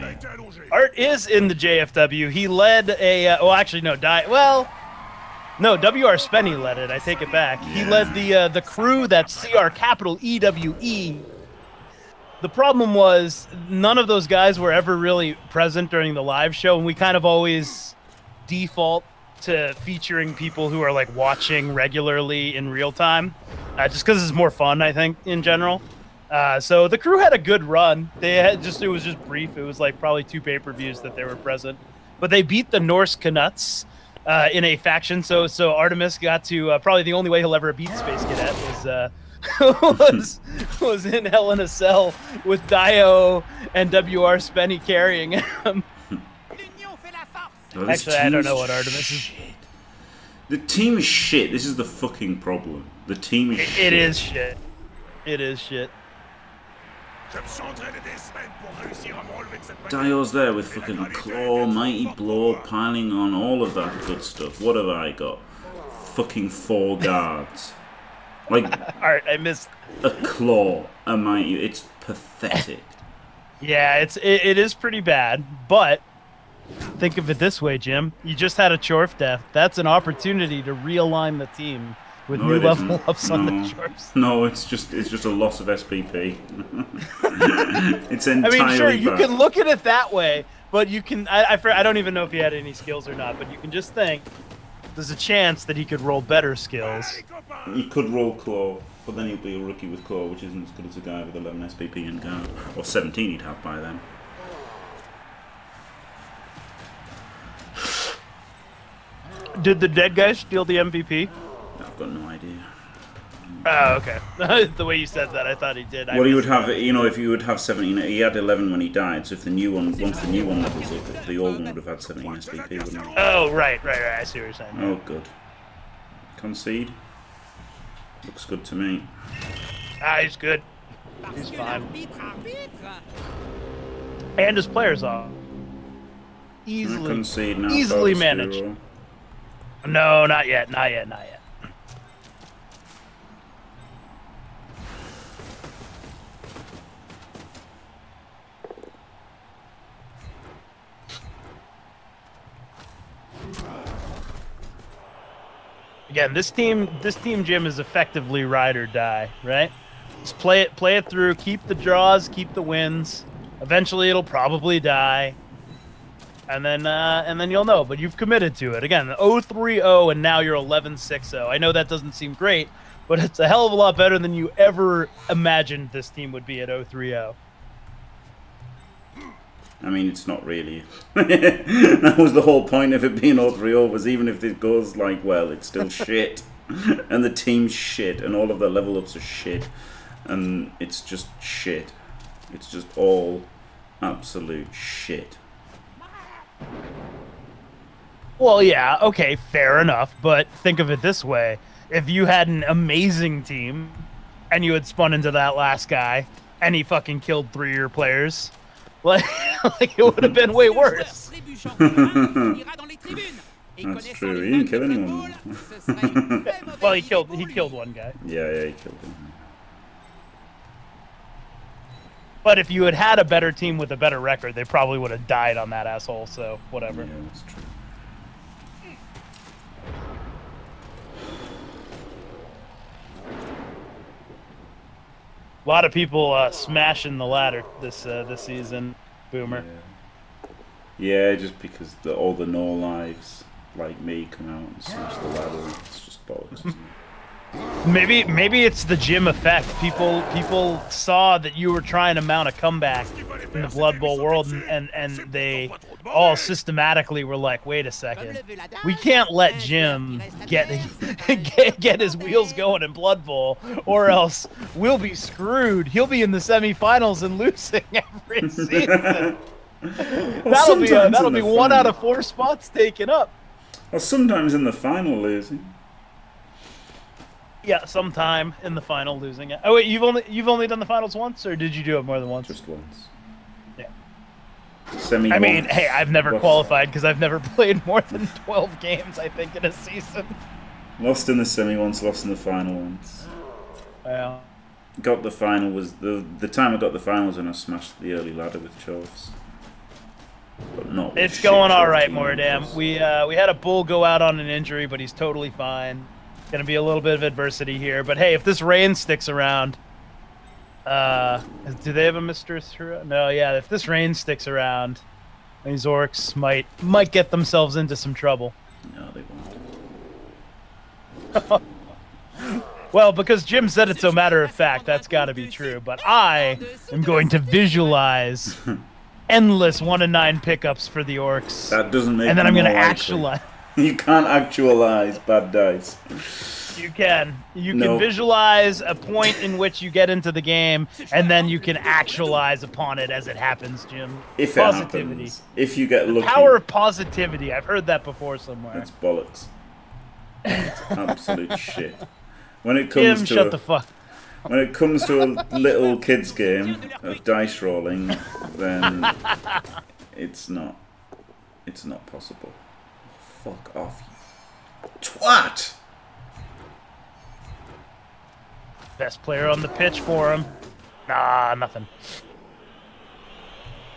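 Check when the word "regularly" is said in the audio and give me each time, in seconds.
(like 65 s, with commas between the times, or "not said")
21 s.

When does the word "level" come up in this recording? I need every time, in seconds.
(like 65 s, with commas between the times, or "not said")
82 s, 120 s, 188 s.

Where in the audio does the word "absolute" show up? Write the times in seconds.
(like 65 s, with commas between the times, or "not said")
194 s, 350 s.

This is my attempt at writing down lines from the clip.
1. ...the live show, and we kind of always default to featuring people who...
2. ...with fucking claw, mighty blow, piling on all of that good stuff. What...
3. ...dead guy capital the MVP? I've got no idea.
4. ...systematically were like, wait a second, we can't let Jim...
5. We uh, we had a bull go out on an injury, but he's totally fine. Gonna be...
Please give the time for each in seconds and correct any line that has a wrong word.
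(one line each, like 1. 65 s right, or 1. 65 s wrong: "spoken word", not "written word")
1. 16 s right
2. 60 s right
3. 109 s wrong: "steal", not "capital"
4. 256 s right
5. 302 s right.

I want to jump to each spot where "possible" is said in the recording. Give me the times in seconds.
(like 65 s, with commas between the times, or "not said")
362 s.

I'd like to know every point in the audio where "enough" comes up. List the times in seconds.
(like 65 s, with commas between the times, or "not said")
199 s.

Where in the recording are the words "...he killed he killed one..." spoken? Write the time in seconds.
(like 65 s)
216 s.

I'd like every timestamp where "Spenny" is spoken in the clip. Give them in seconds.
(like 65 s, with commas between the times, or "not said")
6 s, 44 s.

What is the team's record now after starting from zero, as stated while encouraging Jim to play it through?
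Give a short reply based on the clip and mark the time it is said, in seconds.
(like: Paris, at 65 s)
1160, at 170 s.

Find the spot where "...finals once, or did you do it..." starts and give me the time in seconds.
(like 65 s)
280 s.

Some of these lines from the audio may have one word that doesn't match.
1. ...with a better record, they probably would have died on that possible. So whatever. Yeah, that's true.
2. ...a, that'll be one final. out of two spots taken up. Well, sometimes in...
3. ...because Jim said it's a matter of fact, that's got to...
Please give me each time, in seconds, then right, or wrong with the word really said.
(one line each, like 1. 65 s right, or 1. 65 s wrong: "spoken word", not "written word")
1. 223 s wrong: "asshole", not "possible"
2. 270 s wrong: "four", not "two"
3. 323 s right.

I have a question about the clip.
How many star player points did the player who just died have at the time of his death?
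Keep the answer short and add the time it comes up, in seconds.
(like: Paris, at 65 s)
11, at 117 s.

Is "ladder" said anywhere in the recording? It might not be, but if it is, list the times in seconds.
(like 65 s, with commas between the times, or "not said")
237 s, 245 s, 298 s.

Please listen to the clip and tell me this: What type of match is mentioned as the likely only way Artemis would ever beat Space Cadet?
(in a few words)
Hell in a Cell.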